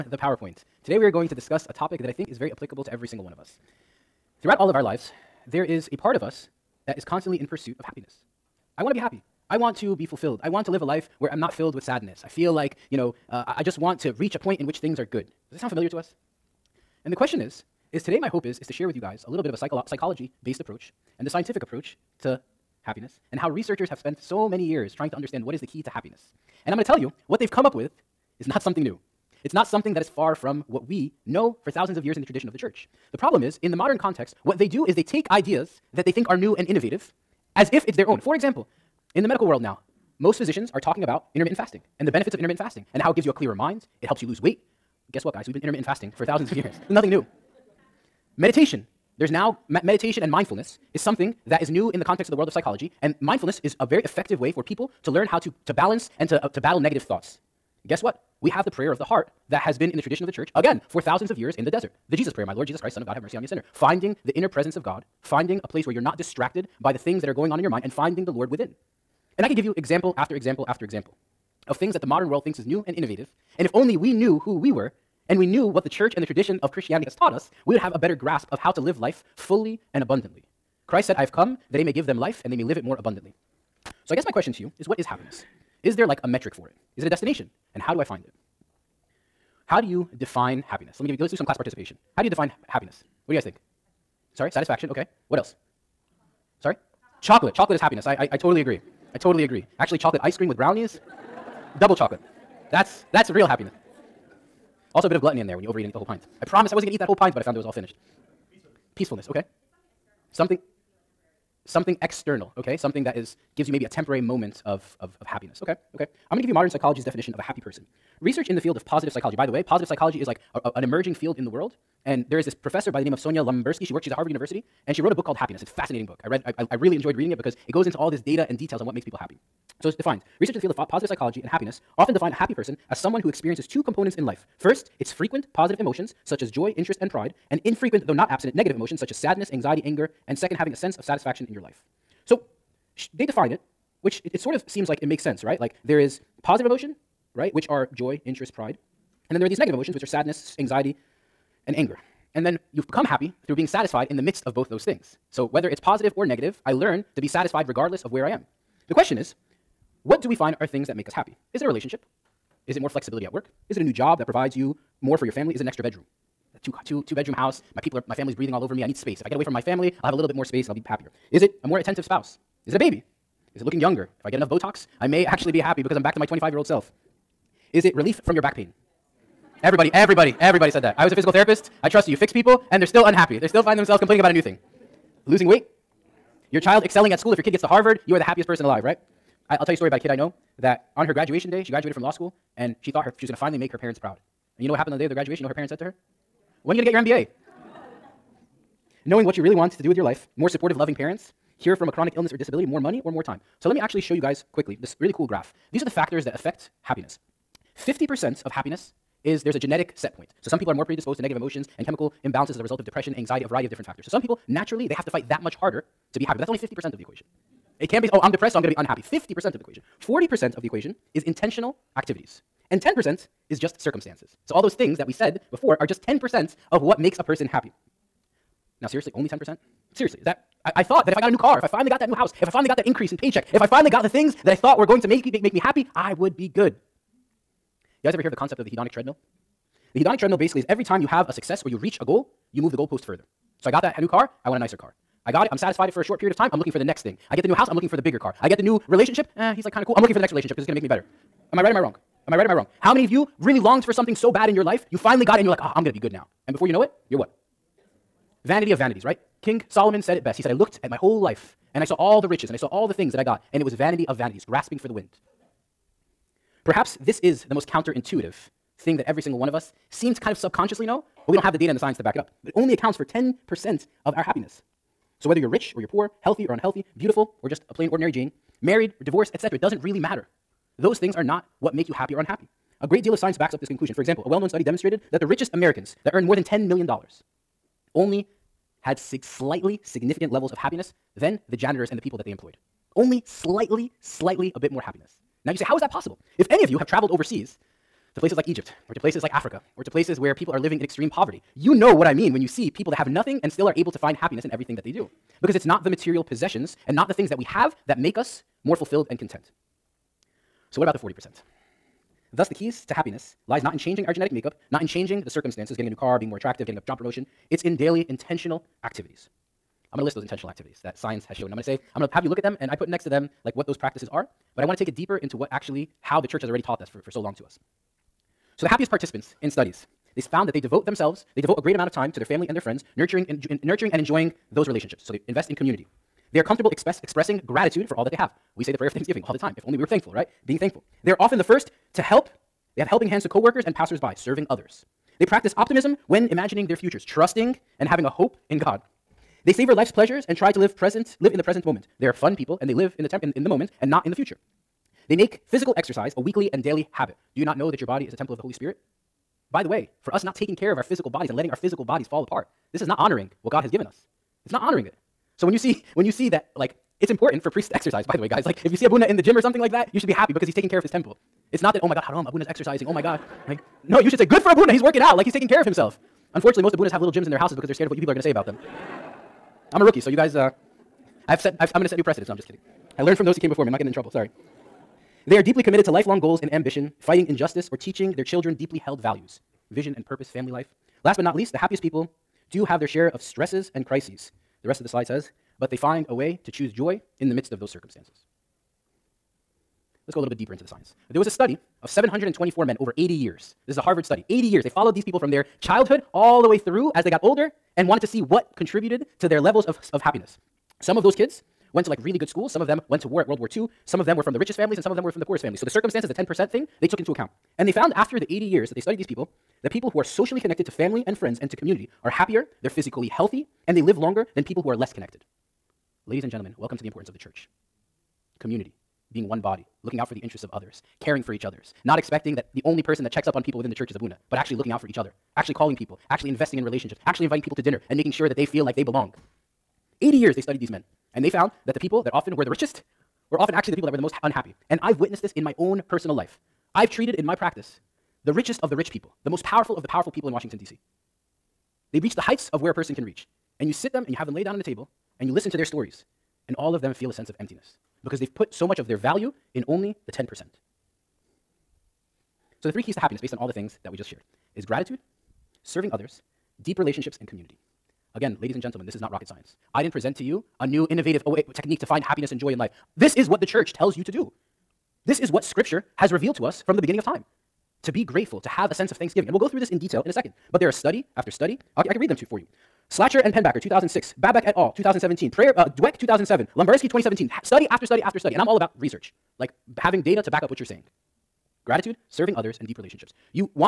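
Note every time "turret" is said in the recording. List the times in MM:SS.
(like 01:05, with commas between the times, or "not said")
not said.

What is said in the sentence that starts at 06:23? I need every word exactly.
I'm not getting in trouble, sorry.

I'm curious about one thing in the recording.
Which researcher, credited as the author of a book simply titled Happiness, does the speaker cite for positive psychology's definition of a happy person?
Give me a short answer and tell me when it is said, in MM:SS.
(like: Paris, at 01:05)
Sonja Lyubomirsky, at 02:03.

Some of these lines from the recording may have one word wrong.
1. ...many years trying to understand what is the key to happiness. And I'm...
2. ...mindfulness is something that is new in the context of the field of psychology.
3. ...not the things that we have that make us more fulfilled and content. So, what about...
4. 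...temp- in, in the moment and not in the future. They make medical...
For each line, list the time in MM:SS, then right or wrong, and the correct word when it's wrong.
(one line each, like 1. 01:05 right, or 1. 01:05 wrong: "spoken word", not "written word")
1. 00:24 right
2. 00:50 wrong: "world", not "field"
3. 05:06 right
4. 05:53 wrong: "physical", not "medical".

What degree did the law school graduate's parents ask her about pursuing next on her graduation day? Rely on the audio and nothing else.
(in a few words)
MBA.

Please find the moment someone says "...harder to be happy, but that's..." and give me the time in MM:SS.
03:35.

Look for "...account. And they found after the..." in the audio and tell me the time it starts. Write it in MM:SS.
06:57.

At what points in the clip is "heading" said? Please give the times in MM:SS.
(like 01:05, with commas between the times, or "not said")
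not said.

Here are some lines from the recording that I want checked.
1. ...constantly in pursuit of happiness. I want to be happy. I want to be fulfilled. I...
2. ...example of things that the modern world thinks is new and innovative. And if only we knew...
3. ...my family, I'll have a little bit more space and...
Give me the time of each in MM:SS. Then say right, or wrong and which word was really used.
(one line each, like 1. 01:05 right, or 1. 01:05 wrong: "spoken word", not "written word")
1. 00:07 right
2. 01:10 right
3. 02:49 right.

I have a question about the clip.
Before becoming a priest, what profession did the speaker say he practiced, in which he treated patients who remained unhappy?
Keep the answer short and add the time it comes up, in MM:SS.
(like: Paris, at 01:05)
Physical therapist, at 03:01.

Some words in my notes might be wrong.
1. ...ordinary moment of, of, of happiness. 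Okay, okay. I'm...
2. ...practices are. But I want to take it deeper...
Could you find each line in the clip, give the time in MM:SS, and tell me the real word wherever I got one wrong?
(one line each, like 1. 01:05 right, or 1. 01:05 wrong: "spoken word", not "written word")
1. 01:53 wrong: "temporary", not "ordinary"
2. 05:23 right.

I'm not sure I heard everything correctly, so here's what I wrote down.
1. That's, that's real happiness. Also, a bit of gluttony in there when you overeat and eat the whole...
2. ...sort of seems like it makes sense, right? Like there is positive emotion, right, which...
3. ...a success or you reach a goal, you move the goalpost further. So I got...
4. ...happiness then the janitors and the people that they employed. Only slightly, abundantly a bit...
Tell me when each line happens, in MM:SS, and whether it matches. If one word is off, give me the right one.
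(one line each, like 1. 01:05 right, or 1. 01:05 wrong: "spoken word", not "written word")
1. 01:42 right
2. 02:24 right
3. 04:01 right
4. 04:50 wrong: "slightly", not "abundantly".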